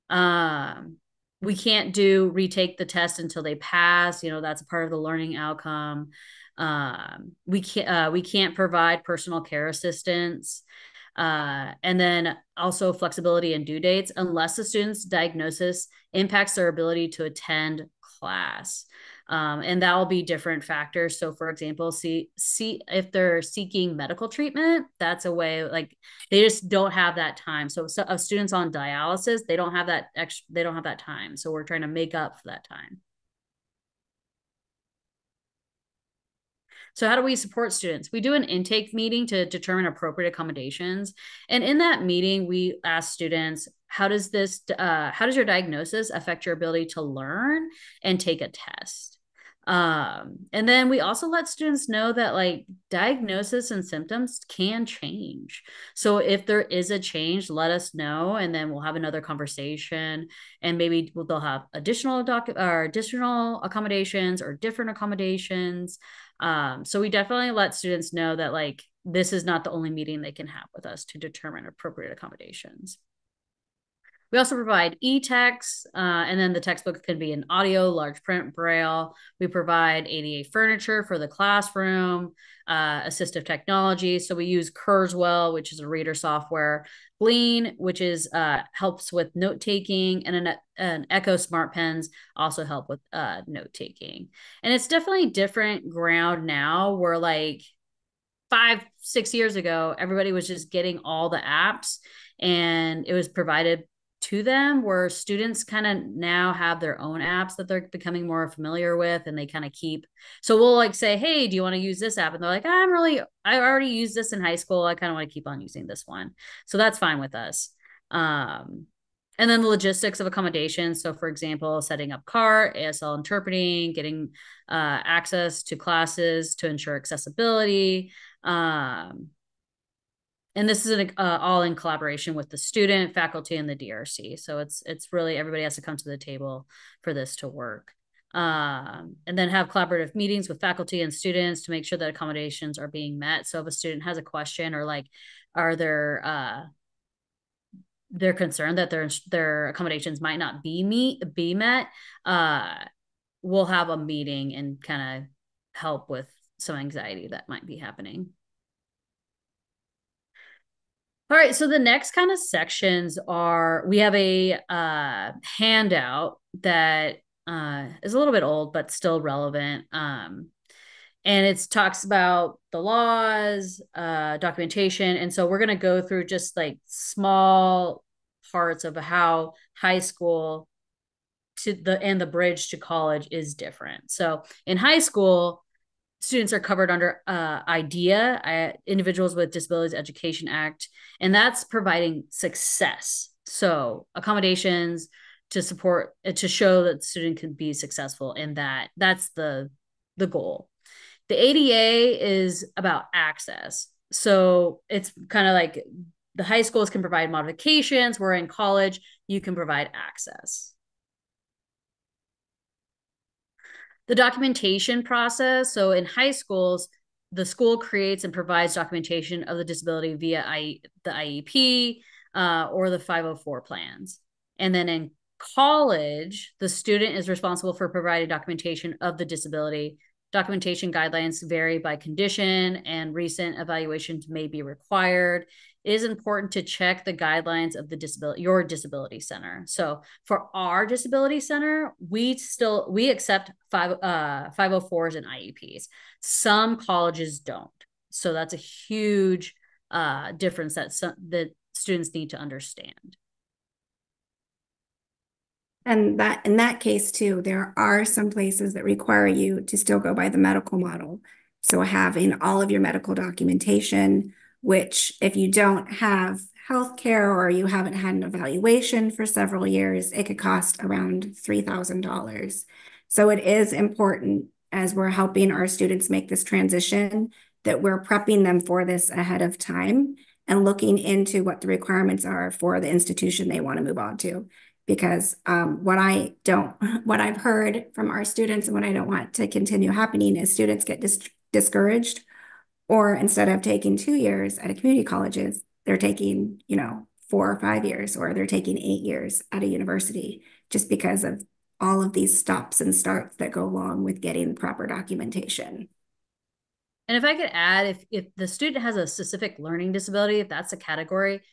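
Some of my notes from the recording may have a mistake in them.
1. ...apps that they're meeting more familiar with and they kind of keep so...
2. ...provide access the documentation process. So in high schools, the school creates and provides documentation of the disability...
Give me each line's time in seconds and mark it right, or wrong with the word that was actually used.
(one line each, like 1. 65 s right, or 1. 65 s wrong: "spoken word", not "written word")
1. 107 s wrong: "becoming", not "meeting"
2. 209 s right.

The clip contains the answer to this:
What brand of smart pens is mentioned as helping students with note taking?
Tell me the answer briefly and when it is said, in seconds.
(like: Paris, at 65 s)
Echo, at 91 s.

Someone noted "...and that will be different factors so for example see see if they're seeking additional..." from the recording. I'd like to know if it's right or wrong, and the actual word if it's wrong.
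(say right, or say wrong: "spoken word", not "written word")
wrong: "medical", not "additional".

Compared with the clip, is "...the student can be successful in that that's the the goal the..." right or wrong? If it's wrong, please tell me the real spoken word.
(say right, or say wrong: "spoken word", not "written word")
right.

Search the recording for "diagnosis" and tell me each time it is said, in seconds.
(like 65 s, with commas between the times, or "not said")
15 s, 45 s, 52 s.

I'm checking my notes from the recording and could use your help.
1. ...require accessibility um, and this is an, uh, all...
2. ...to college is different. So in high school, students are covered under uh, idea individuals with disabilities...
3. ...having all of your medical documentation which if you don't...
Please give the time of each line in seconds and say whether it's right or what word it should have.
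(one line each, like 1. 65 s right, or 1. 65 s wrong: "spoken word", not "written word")
1. 126 s wrong: "ensure", not "require"
2. 182 s right
3. 261 s right.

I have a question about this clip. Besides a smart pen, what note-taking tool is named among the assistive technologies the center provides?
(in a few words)
Glean.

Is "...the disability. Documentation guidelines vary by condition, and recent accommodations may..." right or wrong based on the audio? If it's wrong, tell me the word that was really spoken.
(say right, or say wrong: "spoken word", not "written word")
wrong: "evaluations", not "accommodations".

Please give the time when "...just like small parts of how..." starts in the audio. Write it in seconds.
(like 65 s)
176 s.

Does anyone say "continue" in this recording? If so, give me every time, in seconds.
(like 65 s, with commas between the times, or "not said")
289 s.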